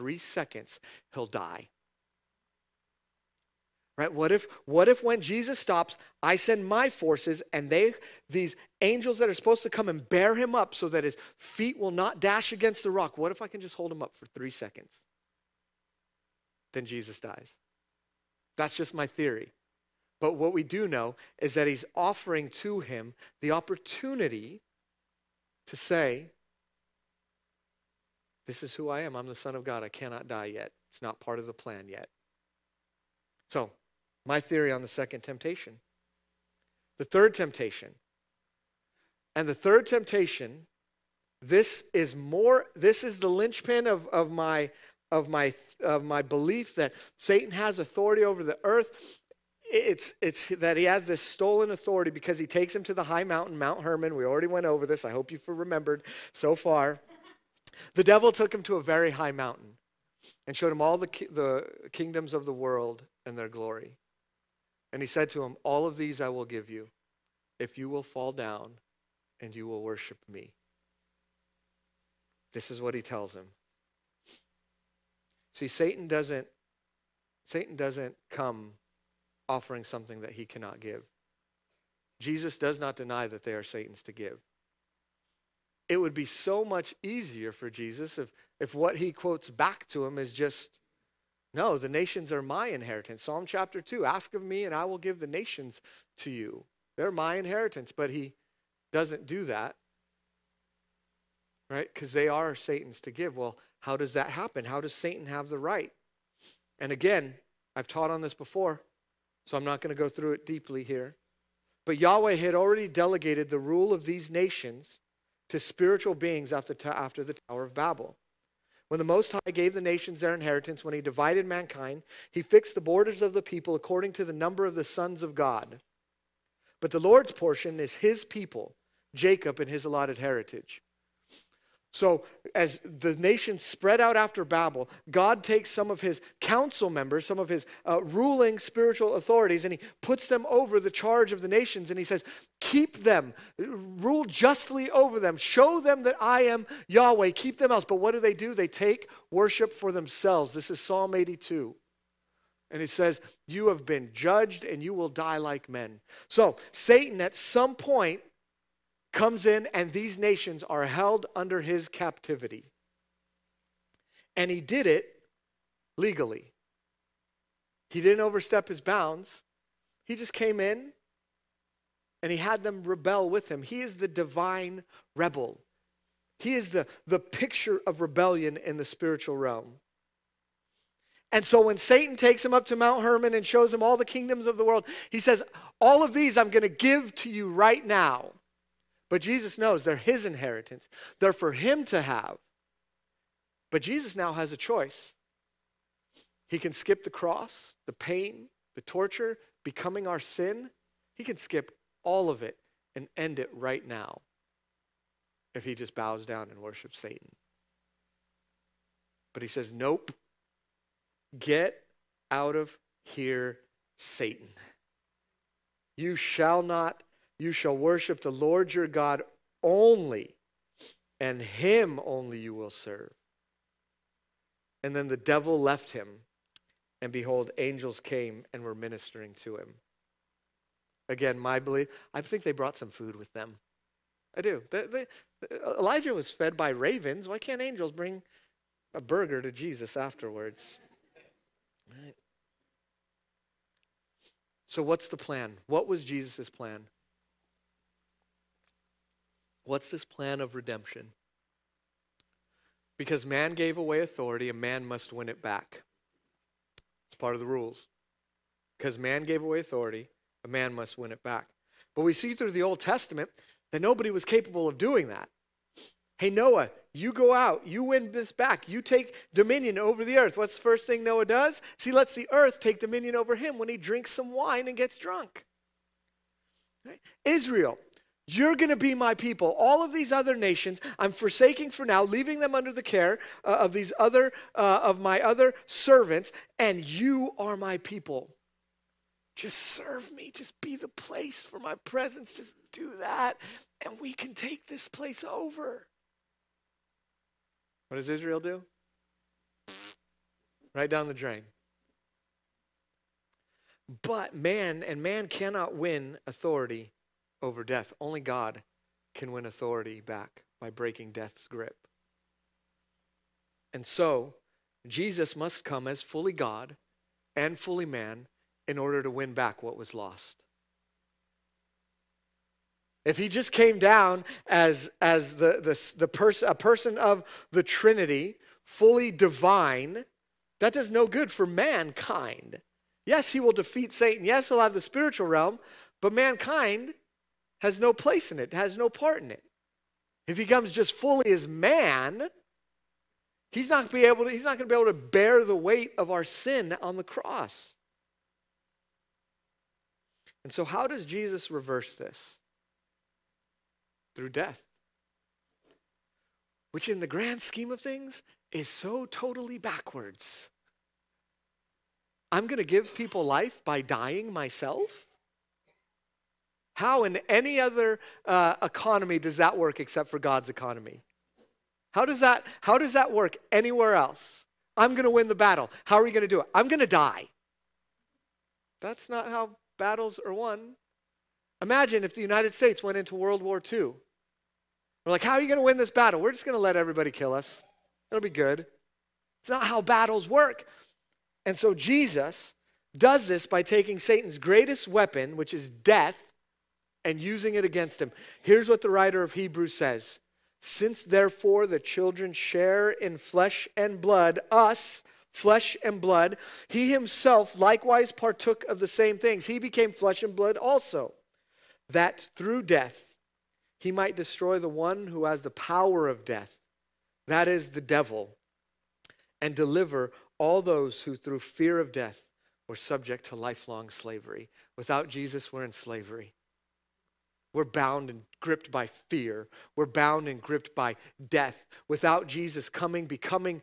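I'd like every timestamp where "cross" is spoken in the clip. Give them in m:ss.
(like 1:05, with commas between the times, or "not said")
3:17, 5:47.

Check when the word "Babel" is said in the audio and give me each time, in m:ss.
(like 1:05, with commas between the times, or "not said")
1:57, 2:14.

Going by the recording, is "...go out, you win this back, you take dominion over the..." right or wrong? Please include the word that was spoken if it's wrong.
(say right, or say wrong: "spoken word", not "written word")
right.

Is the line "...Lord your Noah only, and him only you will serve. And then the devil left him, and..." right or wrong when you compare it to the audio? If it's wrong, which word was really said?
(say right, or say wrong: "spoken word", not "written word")
wrong: "God", not "Noah".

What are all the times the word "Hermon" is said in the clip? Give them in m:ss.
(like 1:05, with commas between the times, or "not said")
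0:53, 3:03.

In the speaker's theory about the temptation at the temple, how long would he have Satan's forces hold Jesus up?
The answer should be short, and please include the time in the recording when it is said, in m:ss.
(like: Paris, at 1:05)
3 seconds, at 0:14.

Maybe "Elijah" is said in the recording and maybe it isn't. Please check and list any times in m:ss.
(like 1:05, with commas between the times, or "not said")
3:55.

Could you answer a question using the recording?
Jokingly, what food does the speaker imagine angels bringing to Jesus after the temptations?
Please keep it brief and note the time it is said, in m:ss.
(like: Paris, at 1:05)
A burger, at 3:58.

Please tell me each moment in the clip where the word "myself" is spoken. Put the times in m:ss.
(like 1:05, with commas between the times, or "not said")
6:04.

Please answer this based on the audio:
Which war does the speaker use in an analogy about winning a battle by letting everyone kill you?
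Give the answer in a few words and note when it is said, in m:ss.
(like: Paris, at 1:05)
World War II, at 6:23.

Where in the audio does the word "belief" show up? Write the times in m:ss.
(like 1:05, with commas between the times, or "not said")
0:46, 3:51.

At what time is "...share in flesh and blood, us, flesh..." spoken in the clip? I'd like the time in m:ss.
6:42.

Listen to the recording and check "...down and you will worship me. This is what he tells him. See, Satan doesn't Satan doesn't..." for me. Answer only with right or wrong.
right.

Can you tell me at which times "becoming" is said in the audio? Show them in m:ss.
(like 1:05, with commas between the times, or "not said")
3:19, 7:13.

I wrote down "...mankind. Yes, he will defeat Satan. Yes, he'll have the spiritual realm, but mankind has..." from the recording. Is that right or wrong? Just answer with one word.
right.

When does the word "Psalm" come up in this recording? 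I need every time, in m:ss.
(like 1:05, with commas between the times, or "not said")
1:33, 2:30.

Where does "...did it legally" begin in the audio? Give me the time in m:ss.
2:44.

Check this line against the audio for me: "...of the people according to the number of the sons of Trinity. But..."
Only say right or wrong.
wrong.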